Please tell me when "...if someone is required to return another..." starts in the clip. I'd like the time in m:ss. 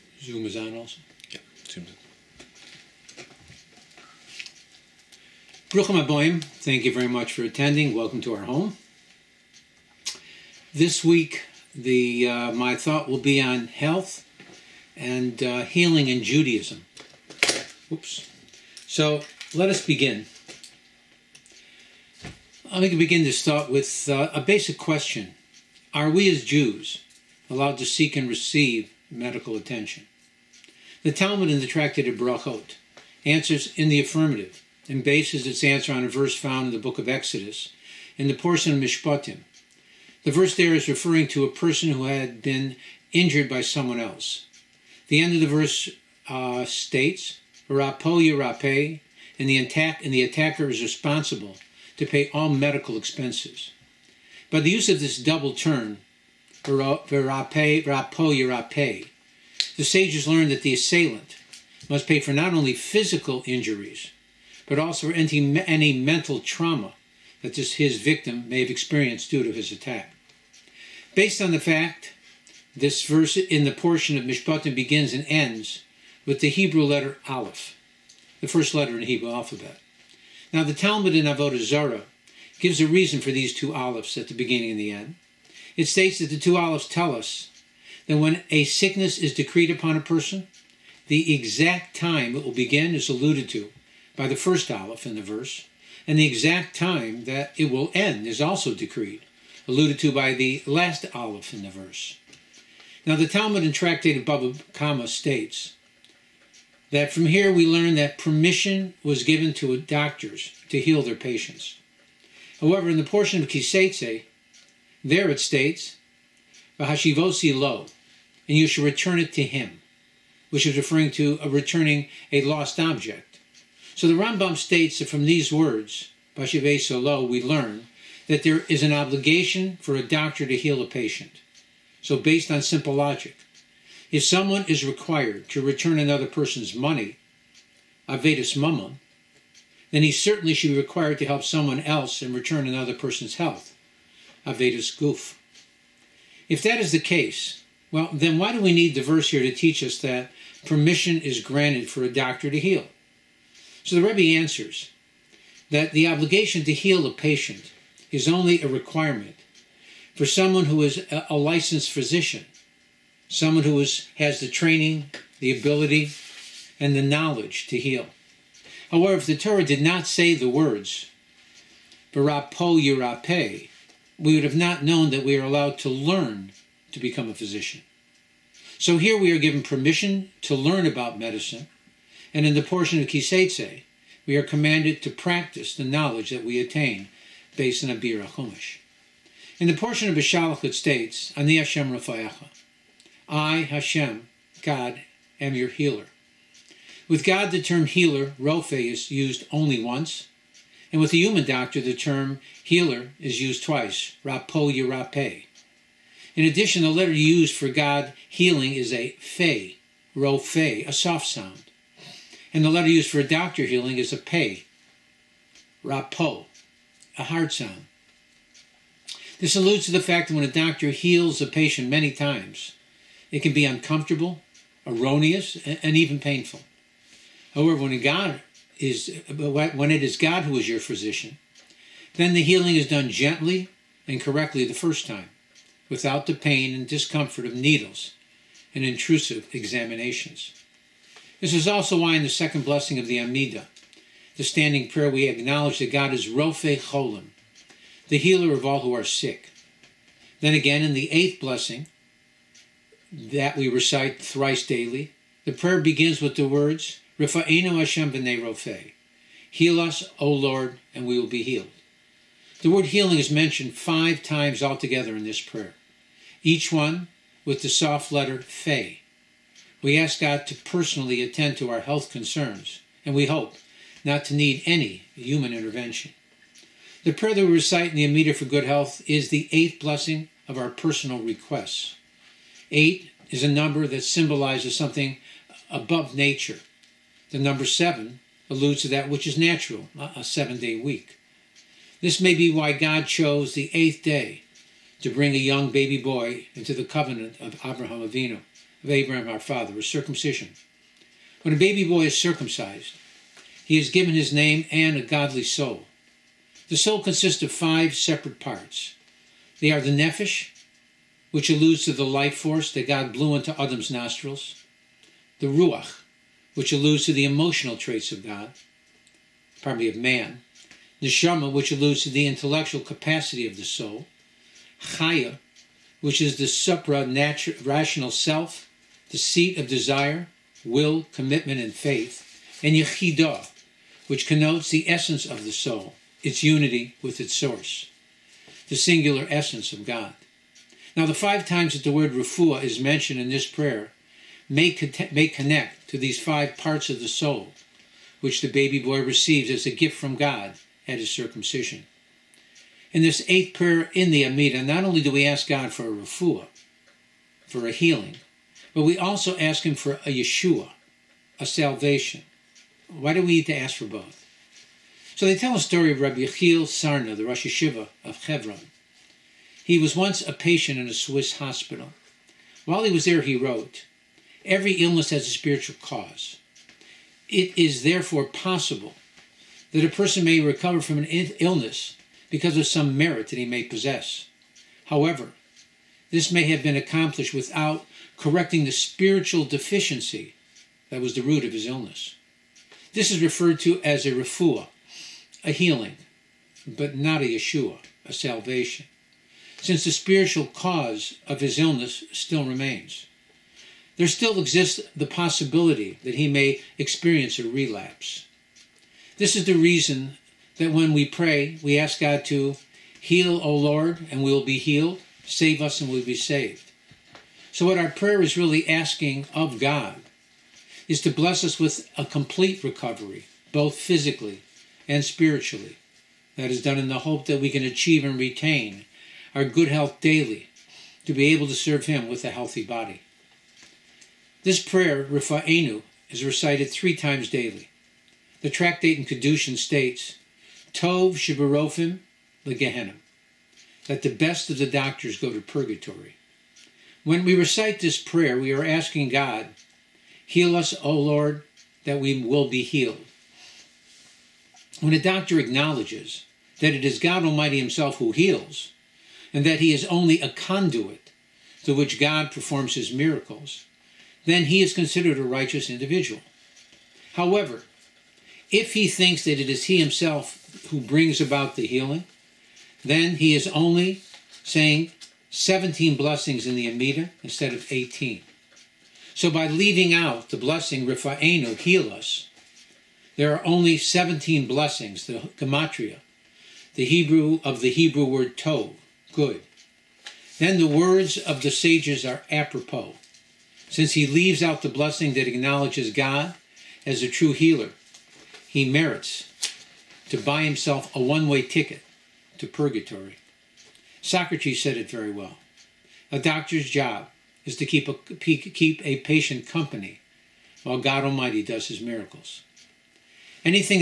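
2:14.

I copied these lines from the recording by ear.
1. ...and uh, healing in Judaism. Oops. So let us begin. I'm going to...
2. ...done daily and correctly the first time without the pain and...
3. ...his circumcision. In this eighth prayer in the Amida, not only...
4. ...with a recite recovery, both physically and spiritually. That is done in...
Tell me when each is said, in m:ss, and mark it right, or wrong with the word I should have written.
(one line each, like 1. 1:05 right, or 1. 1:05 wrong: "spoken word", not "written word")
1. 0:14 right
2. 3:52 wrong: "gently", not "daily"
3. 5:50 right
4. 7:01 wrong: "complete", not "recite".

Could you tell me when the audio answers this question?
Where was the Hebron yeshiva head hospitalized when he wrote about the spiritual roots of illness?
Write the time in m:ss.
6:10.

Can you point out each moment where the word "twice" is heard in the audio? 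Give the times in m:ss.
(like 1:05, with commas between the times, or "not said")
3:23.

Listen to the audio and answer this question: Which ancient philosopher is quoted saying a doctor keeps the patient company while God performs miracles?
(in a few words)
Socrates.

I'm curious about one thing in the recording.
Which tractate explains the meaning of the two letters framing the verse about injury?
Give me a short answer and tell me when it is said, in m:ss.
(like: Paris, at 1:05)
Avodah Zarah, at 1:21.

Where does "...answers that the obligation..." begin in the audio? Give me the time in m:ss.
2:34.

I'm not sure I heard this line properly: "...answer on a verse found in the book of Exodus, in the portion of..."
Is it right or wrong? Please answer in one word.
right.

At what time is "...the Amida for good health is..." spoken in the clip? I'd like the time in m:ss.
4:37.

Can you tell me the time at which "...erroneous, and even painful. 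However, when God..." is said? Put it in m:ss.
3:44.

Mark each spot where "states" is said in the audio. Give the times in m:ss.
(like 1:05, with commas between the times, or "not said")
0:46, 1:25, 1:45, 1:55, 2:04, 3:10, 7:19.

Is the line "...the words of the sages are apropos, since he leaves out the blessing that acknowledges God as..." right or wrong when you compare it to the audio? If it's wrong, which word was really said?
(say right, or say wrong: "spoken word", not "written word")
right.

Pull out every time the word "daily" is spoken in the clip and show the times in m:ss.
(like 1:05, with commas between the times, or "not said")
4:14, 7:10, 7:17.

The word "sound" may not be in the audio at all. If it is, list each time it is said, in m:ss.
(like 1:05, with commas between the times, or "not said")
3:31, 3:37.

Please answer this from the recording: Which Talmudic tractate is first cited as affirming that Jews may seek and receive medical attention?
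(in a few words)
Brachot.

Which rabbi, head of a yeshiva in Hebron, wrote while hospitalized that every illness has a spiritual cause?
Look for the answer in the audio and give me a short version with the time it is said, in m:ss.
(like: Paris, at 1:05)
Rabbi Yechiel Sarna, at 6:06.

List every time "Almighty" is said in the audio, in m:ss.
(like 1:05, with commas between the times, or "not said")
7:37, 8:31.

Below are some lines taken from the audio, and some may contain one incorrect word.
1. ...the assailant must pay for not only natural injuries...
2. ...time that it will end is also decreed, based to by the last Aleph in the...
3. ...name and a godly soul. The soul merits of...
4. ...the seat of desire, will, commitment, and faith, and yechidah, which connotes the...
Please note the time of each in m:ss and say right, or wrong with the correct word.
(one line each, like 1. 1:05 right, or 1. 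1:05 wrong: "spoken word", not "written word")
1. 1:00 wrong: "physical", not "natural"
2. 1:36 wrong: "alluded", not "based"
3. 5:04 wrong: "consists", not "merits"
4. 5:29 right.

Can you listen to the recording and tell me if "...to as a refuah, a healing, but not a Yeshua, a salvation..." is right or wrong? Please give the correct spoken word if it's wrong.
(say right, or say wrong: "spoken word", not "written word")
right.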